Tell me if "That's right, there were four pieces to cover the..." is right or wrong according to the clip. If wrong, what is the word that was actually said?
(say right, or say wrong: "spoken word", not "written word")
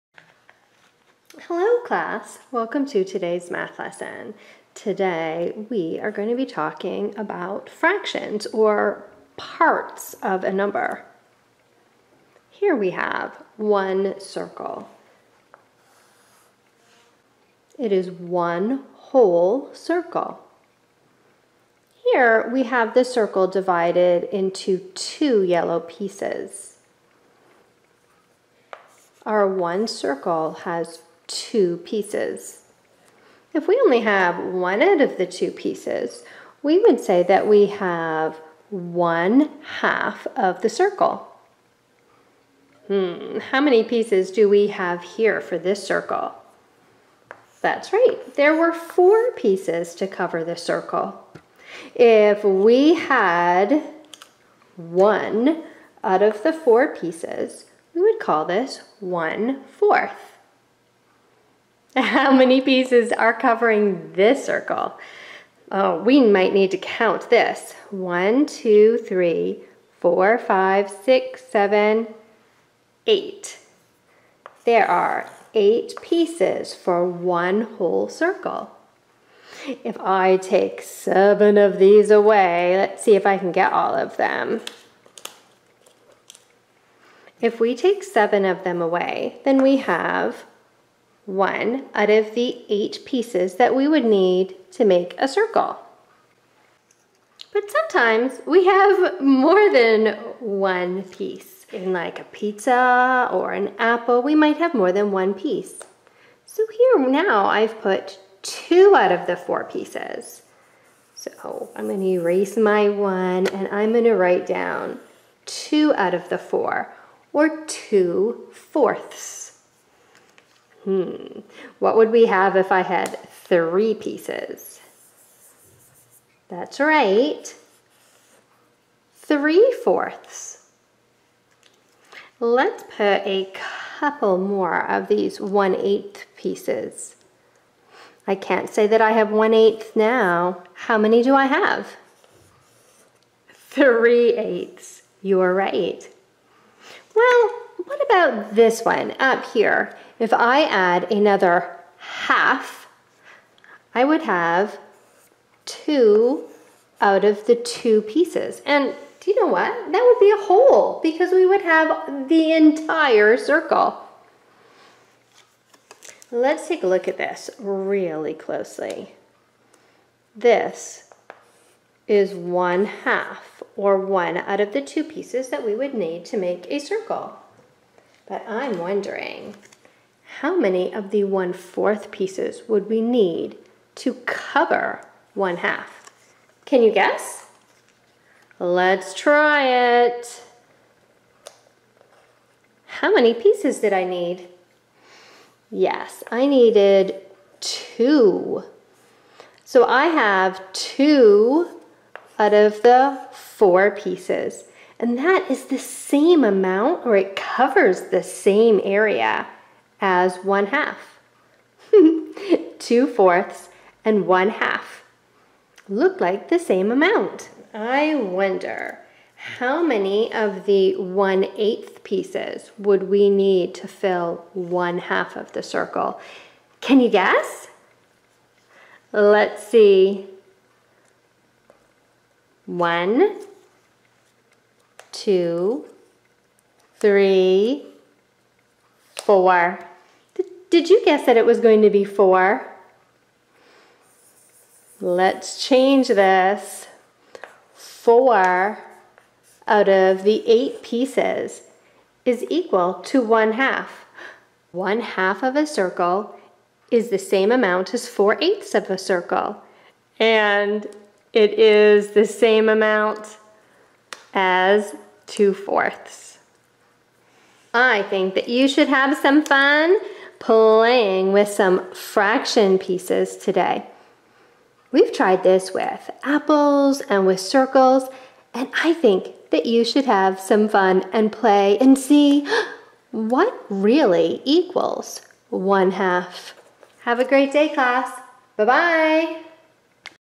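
right.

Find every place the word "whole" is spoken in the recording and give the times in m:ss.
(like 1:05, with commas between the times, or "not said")
0:18, 1:17, 2:40.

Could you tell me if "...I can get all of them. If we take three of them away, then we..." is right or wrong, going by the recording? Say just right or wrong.
wrong.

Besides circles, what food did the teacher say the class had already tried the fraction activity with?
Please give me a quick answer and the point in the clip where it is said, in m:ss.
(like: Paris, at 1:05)
Apples, at 4:36.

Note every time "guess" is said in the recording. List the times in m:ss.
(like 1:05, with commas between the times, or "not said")
3:06, 3:47, 4:01.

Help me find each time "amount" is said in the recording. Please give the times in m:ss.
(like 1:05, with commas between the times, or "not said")
3:26, 3:36, 4:17, 4:22.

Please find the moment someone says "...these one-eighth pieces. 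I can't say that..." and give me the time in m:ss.
2:15.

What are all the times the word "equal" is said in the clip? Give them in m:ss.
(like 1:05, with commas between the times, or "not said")
4:12, 4:44.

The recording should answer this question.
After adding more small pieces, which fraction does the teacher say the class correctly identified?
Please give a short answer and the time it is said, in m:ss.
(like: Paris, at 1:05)
3/8, at 2:23.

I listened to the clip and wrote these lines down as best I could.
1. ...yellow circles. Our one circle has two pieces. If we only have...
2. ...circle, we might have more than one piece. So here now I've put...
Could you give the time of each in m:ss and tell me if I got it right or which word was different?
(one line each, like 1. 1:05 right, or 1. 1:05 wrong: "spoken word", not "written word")
1. 0:25 wrong: "pieces", not "circles"
2. 1:43 wrong: "apple", not "circle".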